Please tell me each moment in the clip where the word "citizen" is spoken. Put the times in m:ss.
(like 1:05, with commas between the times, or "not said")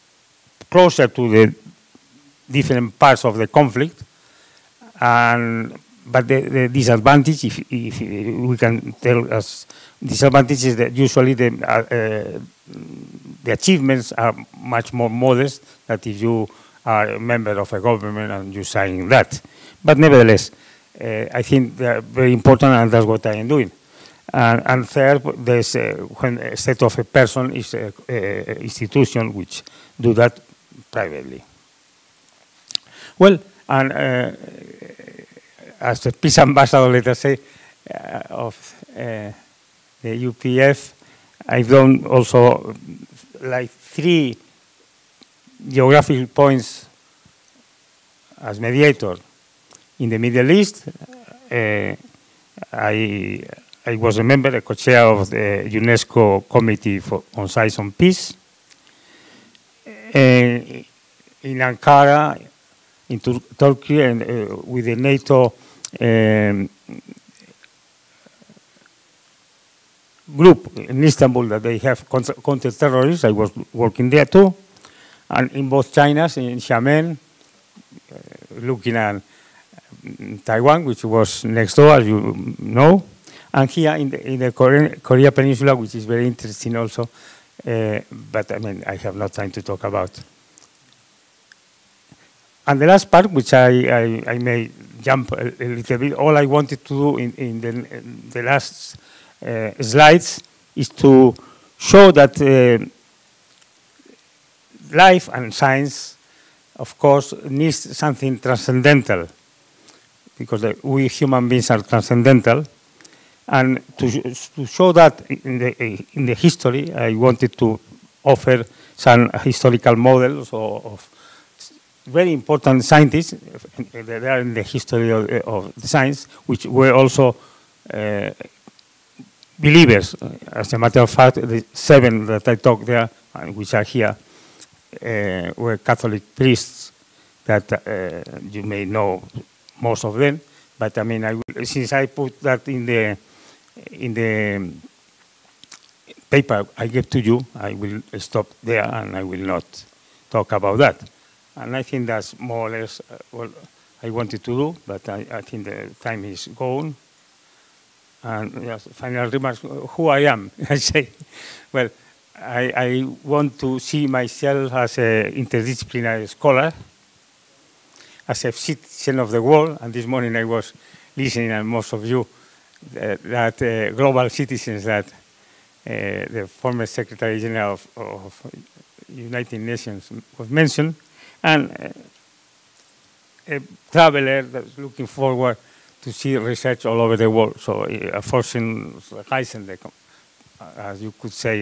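2:48, 2:54.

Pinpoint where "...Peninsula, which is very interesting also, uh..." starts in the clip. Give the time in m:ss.
1:25.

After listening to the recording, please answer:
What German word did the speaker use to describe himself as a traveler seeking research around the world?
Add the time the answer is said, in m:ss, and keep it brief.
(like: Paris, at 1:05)
Forschungsreisender, at 3:08.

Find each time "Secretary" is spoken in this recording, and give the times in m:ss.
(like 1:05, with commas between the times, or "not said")
2:56.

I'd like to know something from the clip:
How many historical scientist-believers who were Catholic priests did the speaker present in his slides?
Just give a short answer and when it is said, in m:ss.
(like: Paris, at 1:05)
7, at 2:11.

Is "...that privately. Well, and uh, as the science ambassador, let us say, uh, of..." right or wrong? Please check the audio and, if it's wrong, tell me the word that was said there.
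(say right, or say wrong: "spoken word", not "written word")
wrong: "peace", not "science".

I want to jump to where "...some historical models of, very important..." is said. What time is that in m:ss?
1:58.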